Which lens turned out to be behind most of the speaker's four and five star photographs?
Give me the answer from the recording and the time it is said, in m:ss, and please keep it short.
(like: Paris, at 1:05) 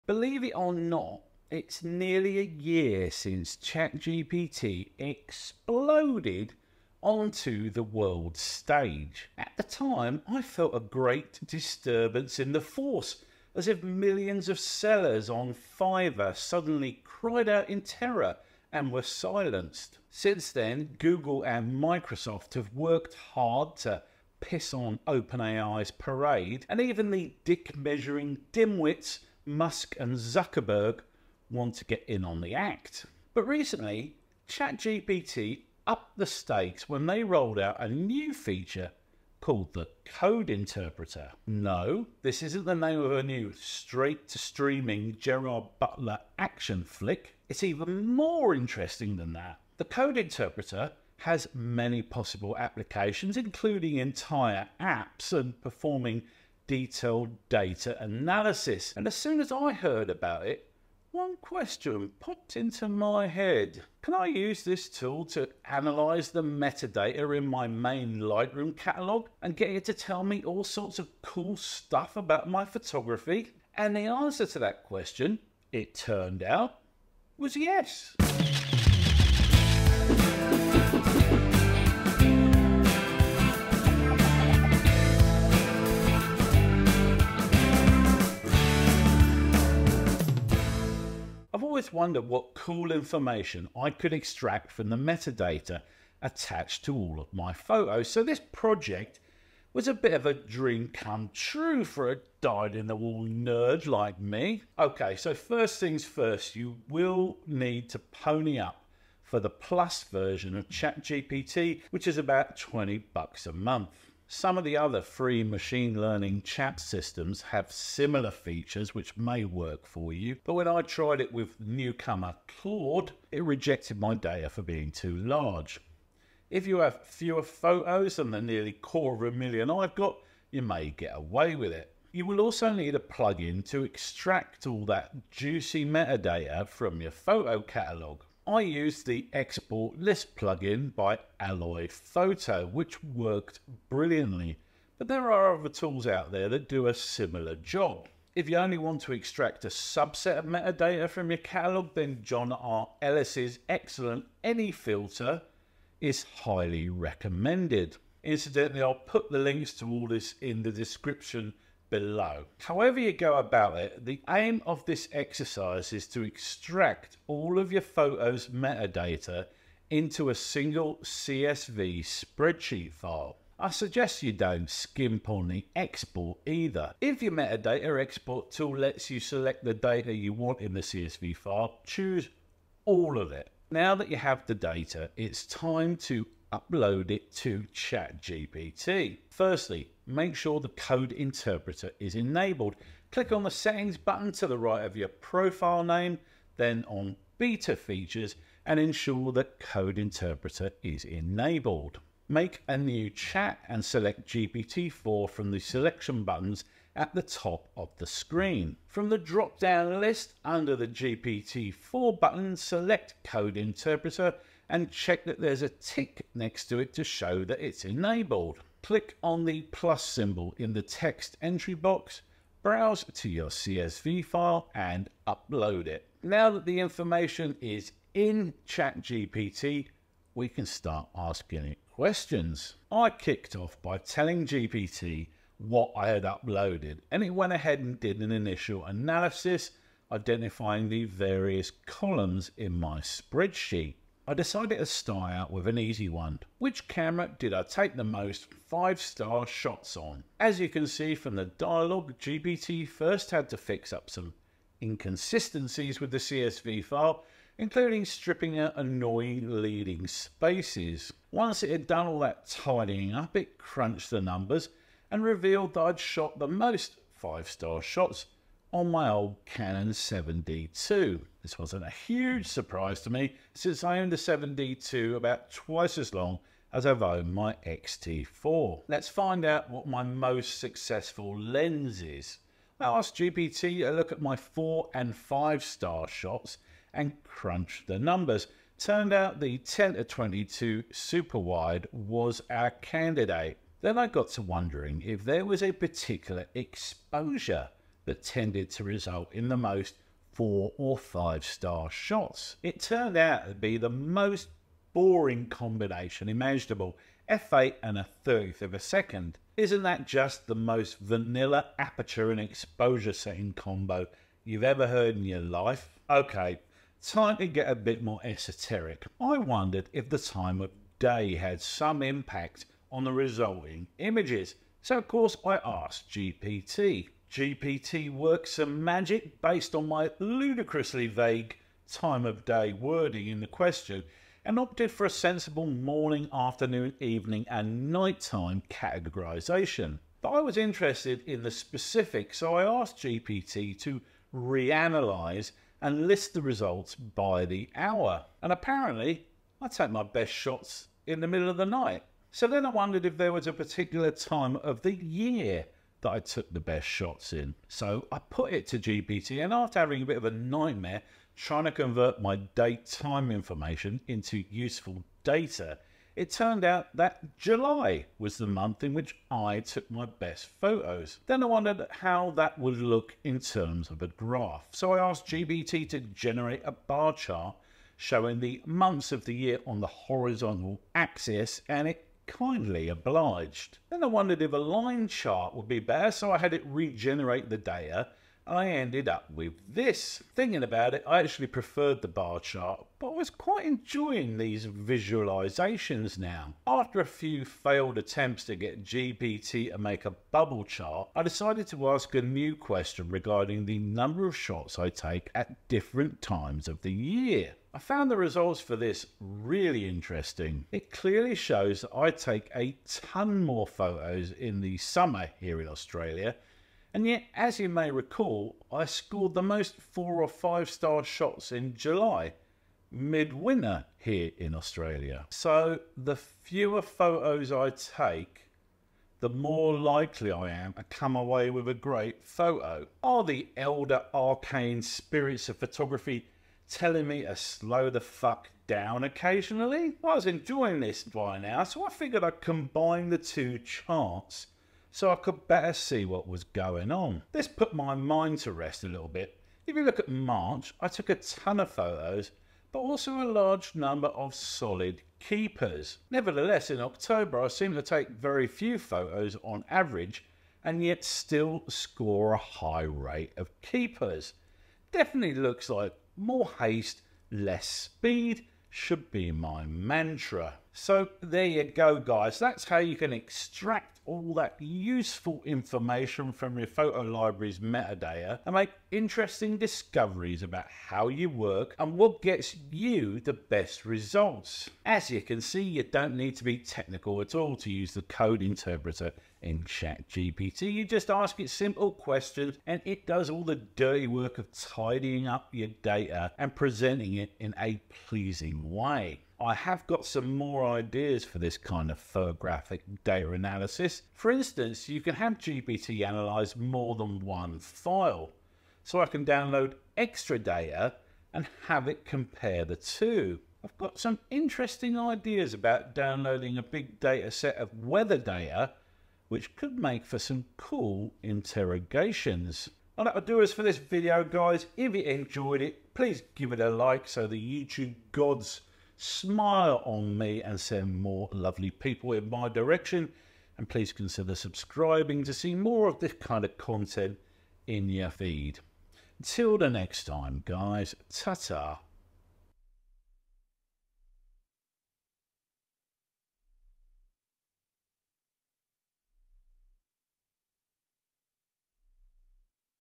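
10 to 22, at 4:49.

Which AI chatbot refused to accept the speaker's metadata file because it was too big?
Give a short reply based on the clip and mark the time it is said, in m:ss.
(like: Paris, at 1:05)
Claude, at 2:02.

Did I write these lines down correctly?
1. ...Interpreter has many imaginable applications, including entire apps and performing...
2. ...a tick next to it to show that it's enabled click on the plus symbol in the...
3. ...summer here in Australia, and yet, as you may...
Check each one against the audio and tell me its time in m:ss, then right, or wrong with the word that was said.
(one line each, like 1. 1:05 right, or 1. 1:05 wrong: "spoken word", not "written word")
1. 0:50 wrong: "possible", not "imaginable"
2. 3:35 right
3. 6:54 right.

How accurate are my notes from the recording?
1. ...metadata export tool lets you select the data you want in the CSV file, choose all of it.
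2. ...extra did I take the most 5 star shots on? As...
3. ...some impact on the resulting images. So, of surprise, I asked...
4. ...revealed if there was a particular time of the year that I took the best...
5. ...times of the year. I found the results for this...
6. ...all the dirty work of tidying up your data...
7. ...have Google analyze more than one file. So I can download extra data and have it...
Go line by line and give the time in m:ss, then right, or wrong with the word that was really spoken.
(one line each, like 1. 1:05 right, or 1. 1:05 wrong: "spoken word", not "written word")
1. 2:57 right
2. 4:06 wrong: "camera", not "extra"
3. 5:21 wrong: "course", not "surprise"
4. 5:52 wrong: "wondered", not "revealed"
5. 6:46 right
6. 8:13 right
7. 8:25 wrong: "GPT", not "Google".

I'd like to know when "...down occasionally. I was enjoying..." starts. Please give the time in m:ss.
7:18.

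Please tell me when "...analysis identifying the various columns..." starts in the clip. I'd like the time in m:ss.
3:58.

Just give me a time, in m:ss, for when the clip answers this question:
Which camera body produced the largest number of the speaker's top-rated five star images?
4:29.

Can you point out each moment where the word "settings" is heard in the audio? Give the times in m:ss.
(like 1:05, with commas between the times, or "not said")
3:13, 5:13.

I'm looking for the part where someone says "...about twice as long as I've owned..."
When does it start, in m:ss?
4:35.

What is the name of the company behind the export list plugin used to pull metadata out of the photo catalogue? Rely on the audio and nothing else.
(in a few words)
Alloy Photo.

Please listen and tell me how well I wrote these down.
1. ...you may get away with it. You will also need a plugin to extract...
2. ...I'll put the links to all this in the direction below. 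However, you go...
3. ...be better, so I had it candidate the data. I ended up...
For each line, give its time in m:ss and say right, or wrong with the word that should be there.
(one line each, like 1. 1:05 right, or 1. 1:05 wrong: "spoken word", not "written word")
1. 2:10 right
2. 2:38 wrong: "description", not "direction"
3. 6:25 wrong: "regenerate", not "candidate".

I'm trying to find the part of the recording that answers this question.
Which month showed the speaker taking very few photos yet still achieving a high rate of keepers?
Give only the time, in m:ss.
7:36.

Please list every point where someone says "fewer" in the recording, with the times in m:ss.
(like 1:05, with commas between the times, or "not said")
2:07, 7:06.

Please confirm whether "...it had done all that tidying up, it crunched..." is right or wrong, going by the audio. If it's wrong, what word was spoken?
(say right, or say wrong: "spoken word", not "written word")
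right.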